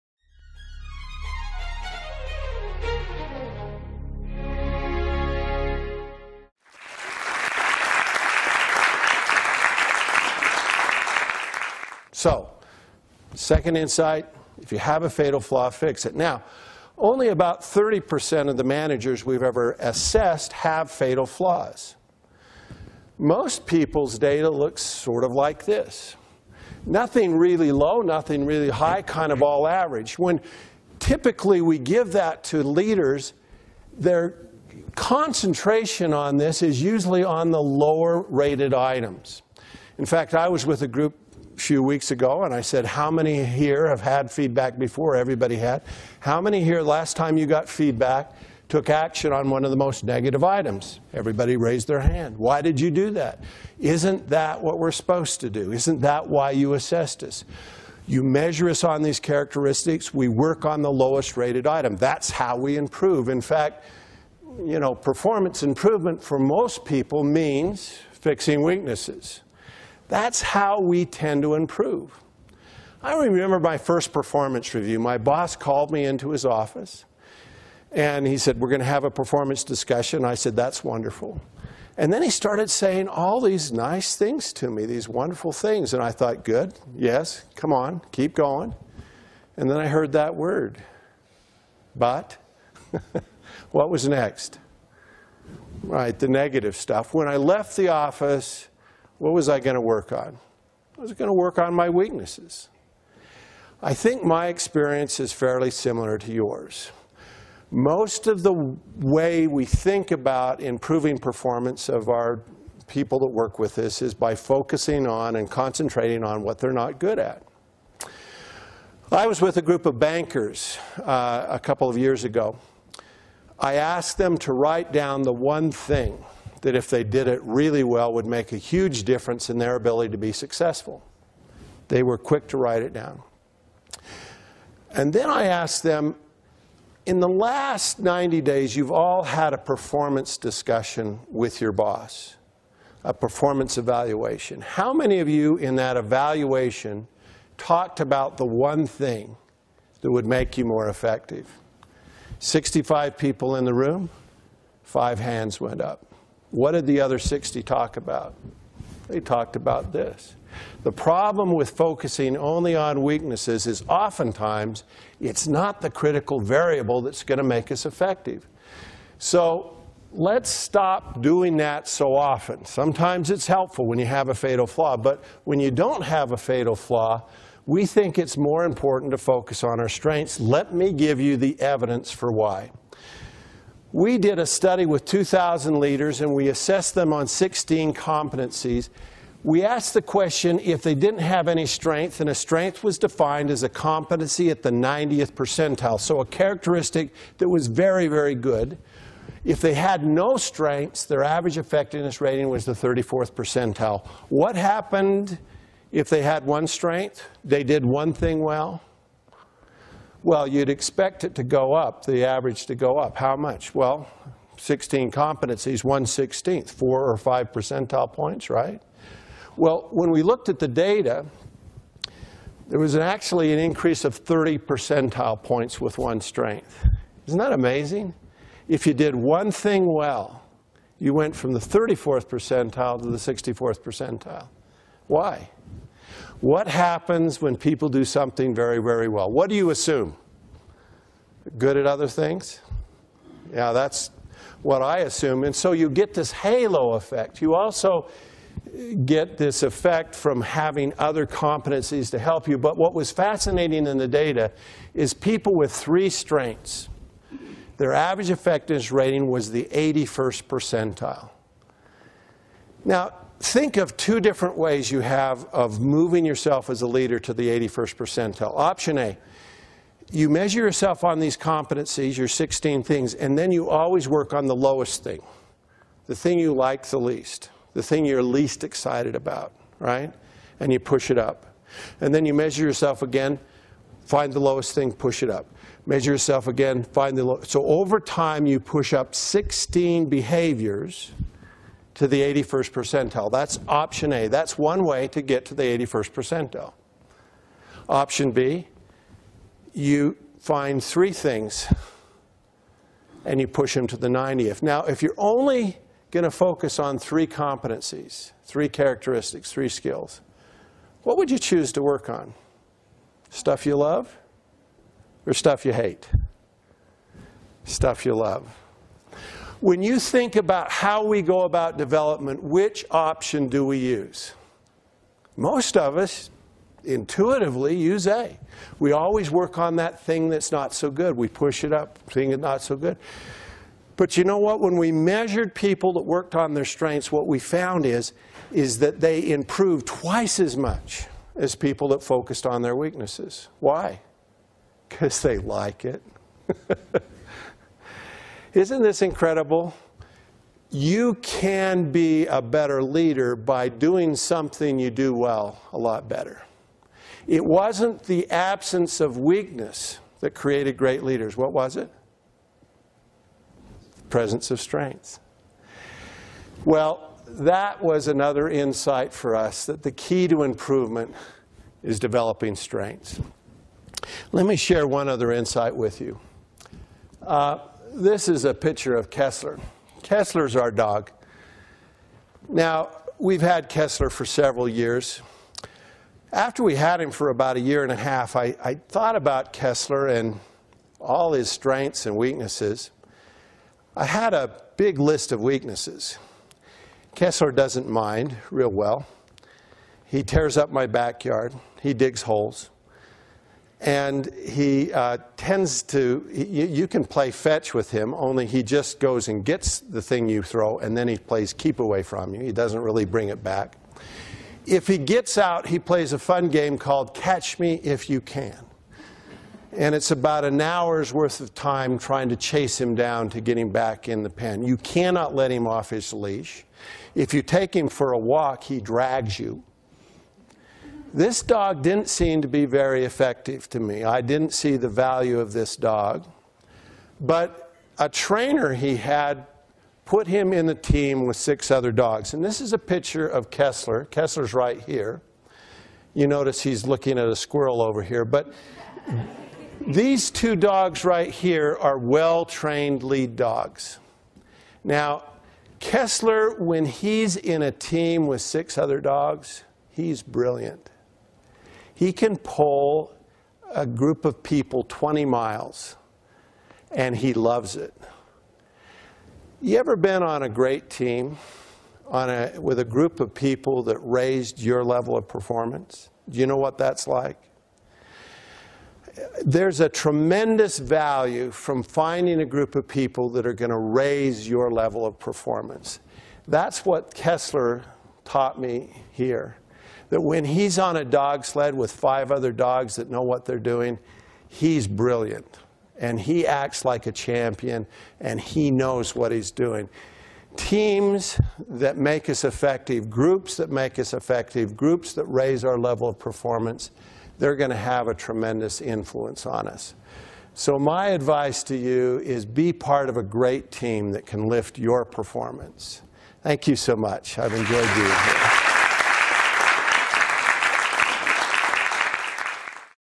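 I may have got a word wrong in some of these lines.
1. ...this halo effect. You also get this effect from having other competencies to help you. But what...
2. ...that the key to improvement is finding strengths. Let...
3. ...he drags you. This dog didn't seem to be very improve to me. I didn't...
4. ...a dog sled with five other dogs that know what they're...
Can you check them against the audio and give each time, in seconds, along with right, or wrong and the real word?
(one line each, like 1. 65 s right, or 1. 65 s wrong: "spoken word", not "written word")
1. 246 s right
2. 369 s wrong: "developing", not "finding"
3. 428 s wrong: "effective", not "improve"
4. 490 s right.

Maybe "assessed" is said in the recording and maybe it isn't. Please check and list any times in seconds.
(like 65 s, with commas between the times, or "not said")
19 s, 56 s, 186 s.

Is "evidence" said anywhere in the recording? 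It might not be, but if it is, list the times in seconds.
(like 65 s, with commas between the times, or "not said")
181 s.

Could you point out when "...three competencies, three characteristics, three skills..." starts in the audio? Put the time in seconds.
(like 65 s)
306 s.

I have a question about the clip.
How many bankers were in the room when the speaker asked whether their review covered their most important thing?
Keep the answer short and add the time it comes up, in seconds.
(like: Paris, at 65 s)
65, at 152 s.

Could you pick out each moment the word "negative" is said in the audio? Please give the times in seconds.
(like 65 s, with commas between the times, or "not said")
50 s, 96 s.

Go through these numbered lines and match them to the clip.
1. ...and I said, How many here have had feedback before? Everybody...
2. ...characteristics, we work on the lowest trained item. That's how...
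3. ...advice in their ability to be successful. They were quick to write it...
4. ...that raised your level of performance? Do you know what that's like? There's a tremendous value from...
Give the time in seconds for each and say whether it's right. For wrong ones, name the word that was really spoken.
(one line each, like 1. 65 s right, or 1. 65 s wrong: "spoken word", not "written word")
1. 42 s right
2. 59 s wrong: "rated", not "trained"
3. 129 s wrong: "difference", not "advice"
4. 473 s right.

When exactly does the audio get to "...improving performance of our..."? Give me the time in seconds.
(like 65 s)
110 s.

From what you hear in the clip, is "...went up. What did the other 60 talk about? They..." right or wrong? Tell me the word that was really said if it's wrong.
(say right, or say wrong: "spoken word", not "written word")
right.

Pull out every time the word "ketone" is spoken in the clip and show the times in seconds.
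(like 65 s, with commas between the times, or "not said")
not said.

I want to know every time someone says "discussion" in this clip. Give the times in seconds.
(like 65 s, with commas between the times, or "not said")
79 s, 140 s.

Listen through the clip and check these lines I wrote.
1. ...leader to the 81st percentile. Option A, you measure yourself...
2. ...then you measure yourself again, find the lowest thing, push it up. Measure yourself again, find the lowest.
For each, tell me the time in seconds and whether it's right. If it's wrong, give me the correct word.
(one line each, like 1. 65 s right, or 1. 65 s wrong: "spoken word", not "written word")
1. 266 s right
2. 282 s right.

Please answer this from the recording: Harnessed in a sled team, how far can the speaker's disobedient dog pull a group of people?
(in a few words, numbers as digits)
20 miles.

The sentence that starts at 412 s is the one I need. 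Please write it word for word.
He doesn't really bring it back.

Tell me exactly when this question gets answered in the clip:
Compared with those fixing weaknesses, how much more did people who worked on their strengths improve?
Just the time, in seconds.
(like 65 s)
339 s.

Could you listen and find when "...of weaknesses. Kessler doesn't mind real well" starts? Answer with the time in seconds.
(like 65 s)
395 s.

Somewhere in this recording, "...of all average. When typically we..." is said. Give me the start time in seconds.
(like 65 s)
29 s.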